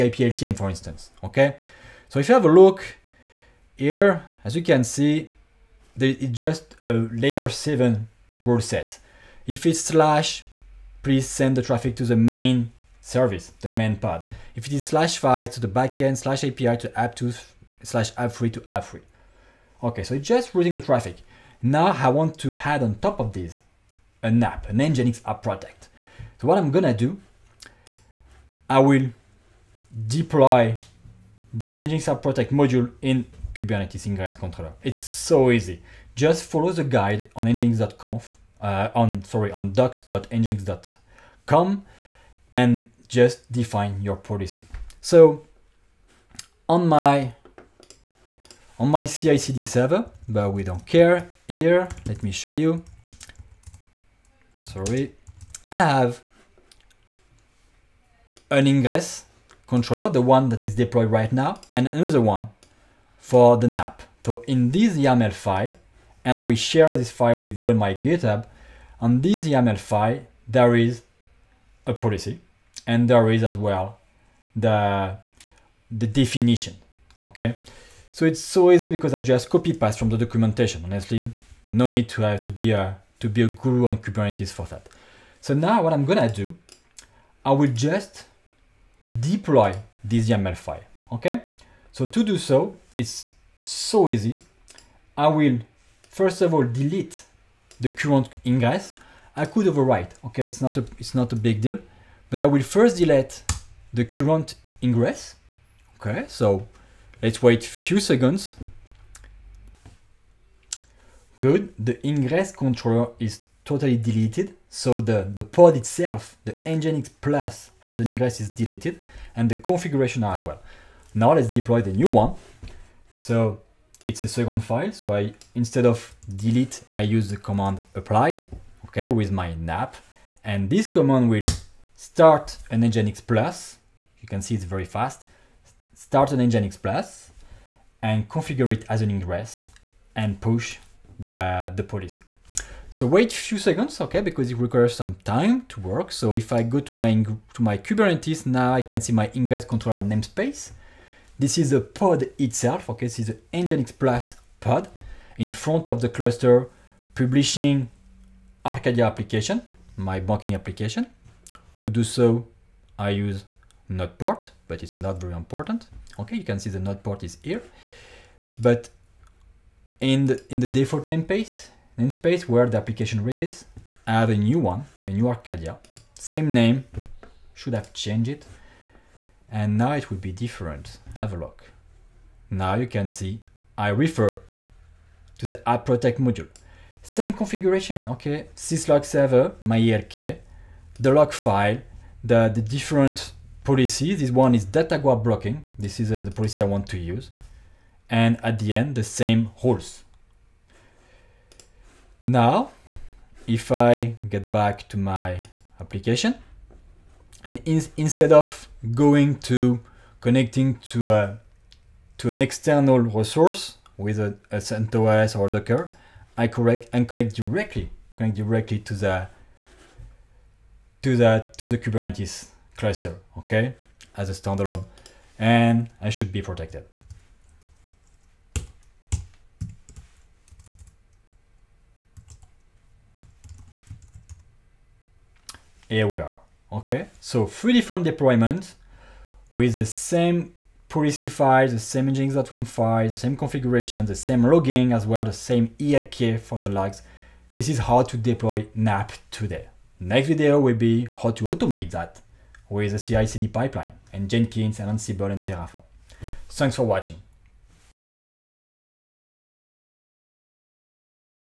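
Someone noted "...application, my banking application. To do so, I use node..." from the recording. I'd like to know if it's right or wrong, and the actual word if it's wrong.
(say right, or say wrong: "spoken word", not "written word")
right.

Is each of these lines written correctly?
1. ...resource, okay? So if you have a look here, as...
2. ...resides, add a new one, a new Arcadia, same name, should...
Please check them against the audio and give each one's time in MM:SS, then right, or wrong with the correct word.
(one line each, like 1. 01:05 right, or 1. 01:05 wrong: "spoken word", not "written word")
1. 00:00 wrong: "instance", not "resource"
2. 02:53 right.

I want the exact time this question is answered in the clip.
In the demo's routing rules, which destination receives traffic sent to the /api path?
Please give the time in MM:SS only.
00:16.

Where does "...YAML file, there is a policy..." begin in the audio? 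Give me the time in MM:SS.
01:09.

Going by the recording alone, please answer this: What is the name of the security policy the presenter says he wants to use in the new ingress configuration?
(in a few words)
data guard blocking.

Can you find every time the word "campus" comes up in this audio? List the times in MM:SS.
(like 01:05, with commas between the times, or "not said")
not said.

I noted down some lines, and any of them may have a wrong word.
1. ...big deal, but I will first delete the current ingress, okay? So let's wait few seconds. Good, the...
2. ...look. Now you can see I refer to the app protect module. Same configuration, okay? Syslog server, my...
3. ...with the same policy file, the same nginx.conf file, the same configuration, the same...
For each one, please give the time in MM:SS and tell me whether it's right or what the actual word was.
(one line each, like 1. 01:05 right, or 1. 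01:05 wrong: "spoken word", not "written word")
1. 01:41 right
2. 03:01 right
3. 03:59 right.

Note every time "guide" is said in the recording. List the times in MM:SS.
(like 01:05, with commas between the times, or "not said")
00:36.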